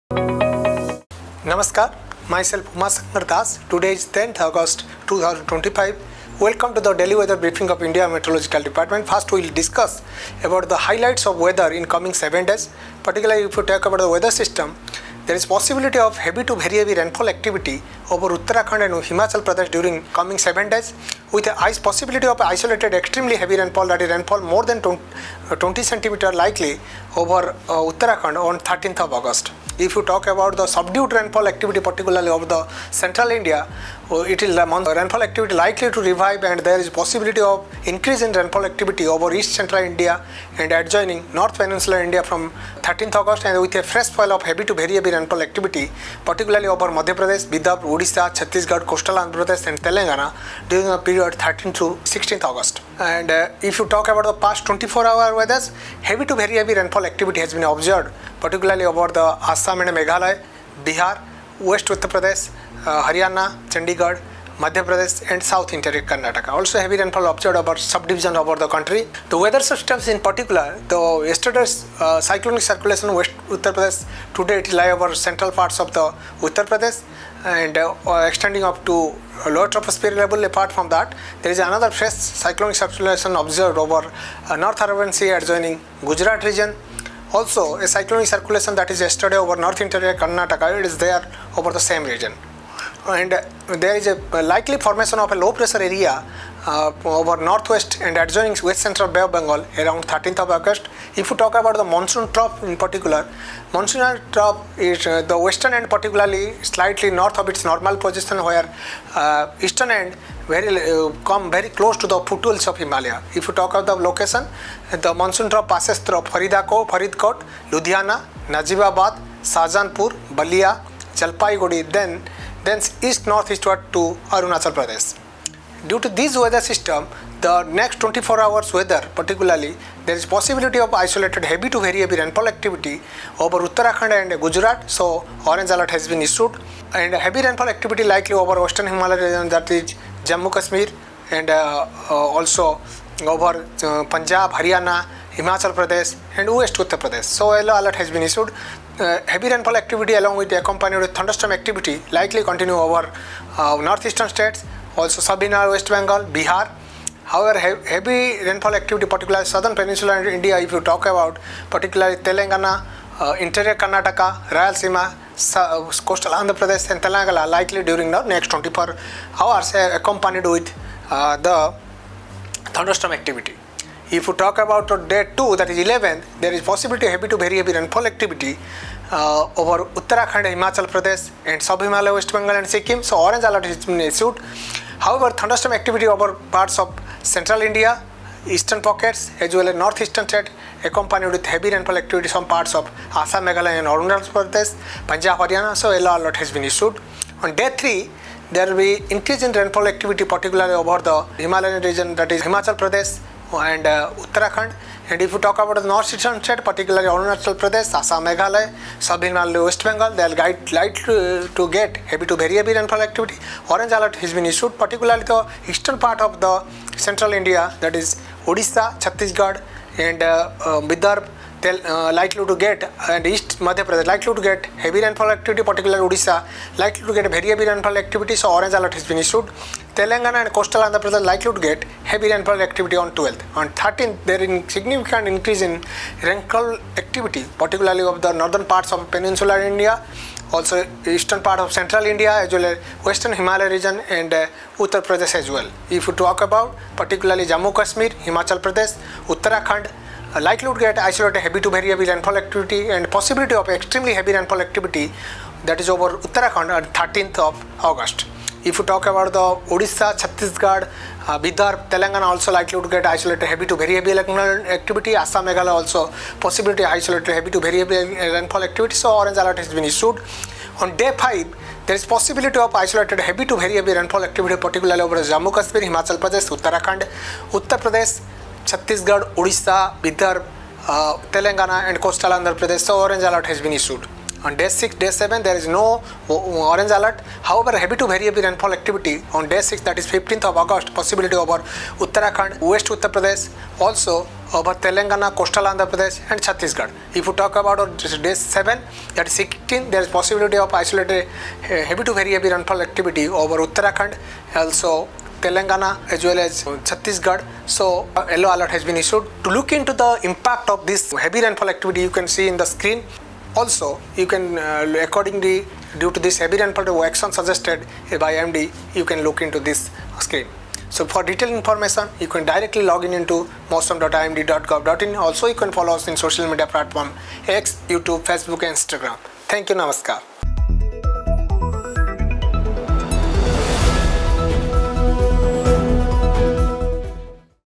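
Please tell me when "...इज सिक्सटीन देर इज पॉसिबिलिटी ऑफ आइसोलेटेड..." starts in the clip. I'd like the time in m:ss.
4:59.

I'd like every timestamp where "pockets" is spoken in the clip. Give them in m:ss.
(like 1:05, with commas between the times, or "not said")
3:08.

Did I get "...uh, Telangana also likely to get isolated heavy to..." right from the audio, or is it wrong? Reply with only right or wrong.
right.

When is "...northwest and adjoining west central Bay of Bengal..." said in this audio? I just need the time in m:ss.
1:37.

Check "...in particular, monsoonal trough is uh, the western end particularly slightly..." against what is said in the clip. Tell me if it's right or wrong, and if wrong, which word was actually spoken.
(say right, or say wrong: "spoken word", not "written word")
right.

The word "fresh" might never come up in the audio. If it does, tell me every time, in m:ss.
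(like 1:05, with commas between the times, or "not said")
0:43, 1:21.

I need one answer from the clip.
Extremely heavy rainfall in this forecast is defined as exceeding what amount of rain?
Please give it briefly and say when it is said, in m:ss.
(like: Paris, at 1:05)
20 centimeters, at 0:24.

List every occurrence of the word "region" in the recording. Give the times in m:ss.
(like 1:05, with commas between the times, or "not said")
1:26, 1:32, 2:19, 3:21, 4:03.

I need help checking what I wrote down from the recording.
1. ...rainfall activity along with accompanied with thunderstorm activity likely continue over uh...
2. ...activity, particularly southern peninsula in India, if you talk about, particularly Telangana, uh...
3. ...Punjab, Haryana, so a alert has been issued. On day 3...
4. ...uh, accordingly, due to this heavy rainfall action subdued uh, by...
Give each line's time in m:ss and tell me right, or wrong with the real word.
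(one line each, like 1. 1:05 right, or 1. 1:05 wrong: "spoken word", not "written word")
1. 2:29 right
2. 2:38 right
3. 3:15 right
4. 5:14 wrong: "suggested", not "subdued".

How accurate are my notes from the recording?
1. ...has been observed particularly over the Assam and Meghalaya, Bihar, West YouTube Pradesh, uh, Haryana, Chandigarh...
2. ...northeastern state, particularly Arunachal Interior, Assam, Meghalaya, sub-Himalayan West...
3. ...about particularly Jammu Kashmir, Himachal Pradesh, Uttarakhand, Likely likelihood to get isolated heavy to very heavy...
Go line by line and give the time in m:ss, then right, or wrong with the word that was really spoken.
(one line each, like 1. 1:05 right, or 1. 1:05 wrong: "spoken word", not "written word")
1. 0:57 wrong: "Uttar", not "YouTube"
2. 3:25 wrong: "Pradesh", not "Interior"
3. 4:06 right.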